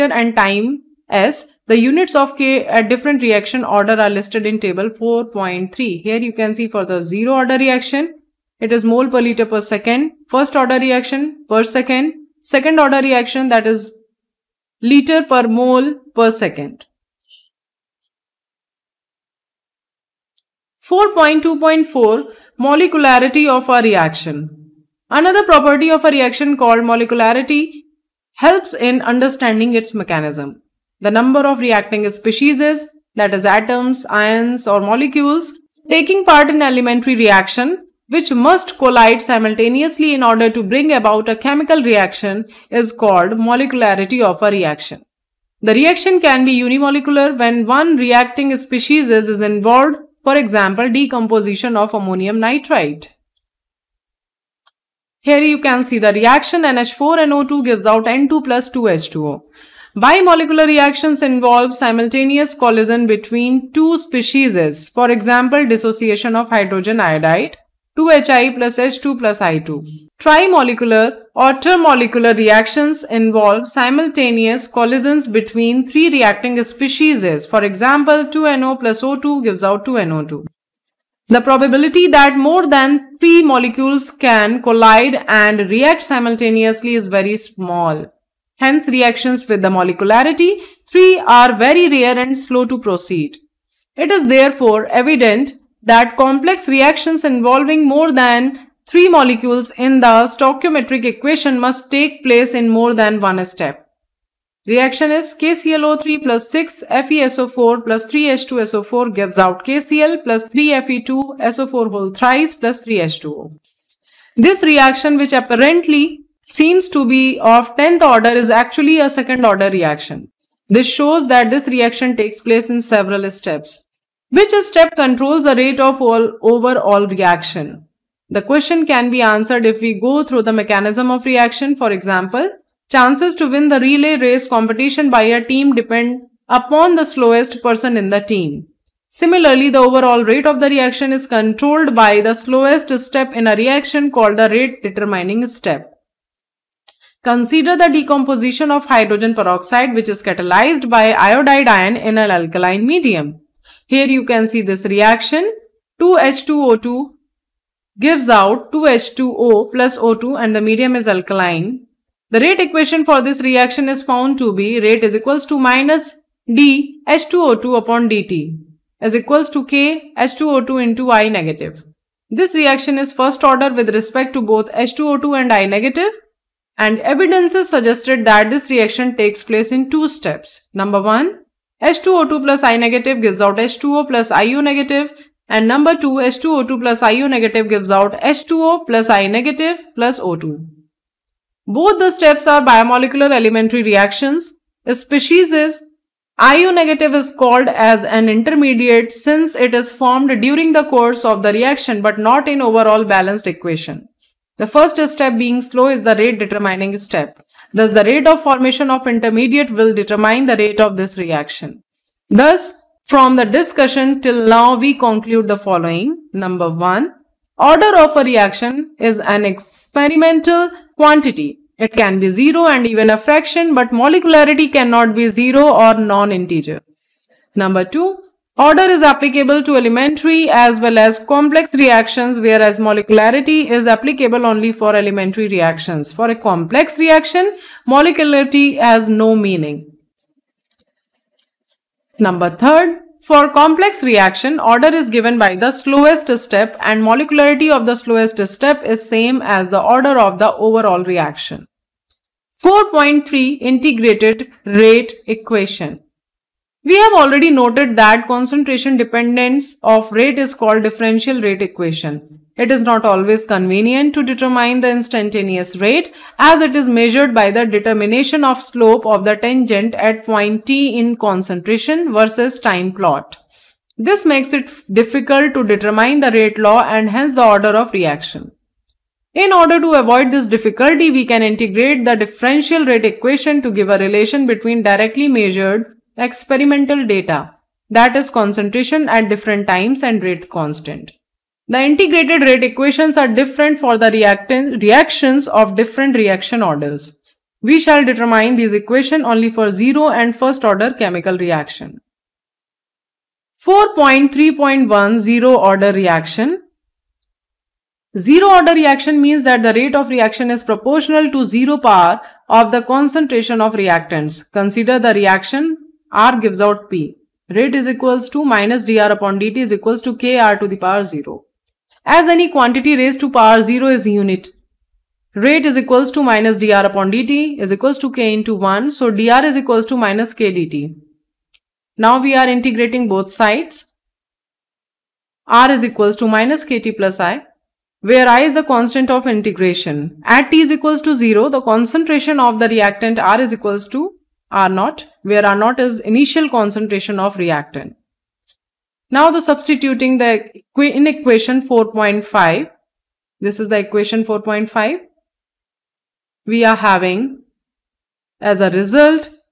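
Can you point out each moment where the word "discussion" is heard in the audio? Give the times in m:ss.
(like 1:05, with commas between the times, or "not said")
3:33.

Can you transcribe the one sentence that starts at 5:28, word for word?
So dr is equals to minus k dt.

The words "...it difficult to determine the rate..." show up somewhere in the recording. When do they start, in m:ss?
4:34.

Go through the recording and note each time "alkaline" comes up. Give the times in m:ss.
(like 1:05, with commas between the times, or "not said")
2:32, 2:41.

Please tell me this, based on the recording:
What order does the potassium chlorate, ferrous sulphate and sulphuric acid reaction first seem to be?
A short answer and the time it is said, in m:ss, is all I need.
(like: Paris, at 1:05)
10th order, at 1:57.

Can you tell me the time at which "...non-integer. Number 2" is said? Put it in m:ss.
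3:45.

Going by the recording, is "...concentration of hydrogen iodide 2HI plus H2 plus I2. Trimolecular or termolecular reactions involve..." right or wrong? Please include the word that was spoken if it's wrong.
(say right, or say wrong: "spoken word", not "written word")
wrong: "dissociation", not "concentration".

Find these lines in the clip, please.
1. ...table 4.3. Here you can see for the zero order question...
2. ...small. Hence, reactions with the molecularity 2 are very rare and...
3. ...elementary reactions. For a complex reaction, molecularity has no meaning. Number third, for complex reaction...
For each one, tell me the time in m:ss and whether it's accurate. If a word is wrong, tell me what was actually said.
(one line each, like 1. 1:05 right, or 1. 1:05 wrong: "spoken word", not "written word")
1. 0:04 wrong: "reaction", not "question"
2. 1:27 wrong: "3", not "2"
3. 3:54 right.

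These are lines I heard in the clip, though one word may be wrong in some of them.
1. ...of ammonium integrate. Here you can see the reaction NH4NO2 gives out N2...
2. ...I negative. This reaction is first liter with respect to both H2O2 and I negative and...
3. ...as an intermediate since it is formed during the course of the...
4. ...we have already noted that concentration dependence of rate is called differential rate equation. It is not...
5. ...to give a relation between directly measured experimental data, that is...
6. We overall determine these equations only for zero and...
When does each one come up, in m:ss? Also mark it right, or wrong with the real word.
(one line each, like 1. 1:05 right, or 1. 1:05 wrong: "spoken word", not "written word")
1. 0:51 wrong: "nitrite", not "integrate"
2. 2:51 wrong: "order", not "liter"
3. 3:17 right
4. 4:16 right
5. 4:43 right
6. 4:57 wrong: "shall", not "overall".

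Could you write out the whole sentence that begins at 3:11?
Both the steps are bimolecular elementary reactions.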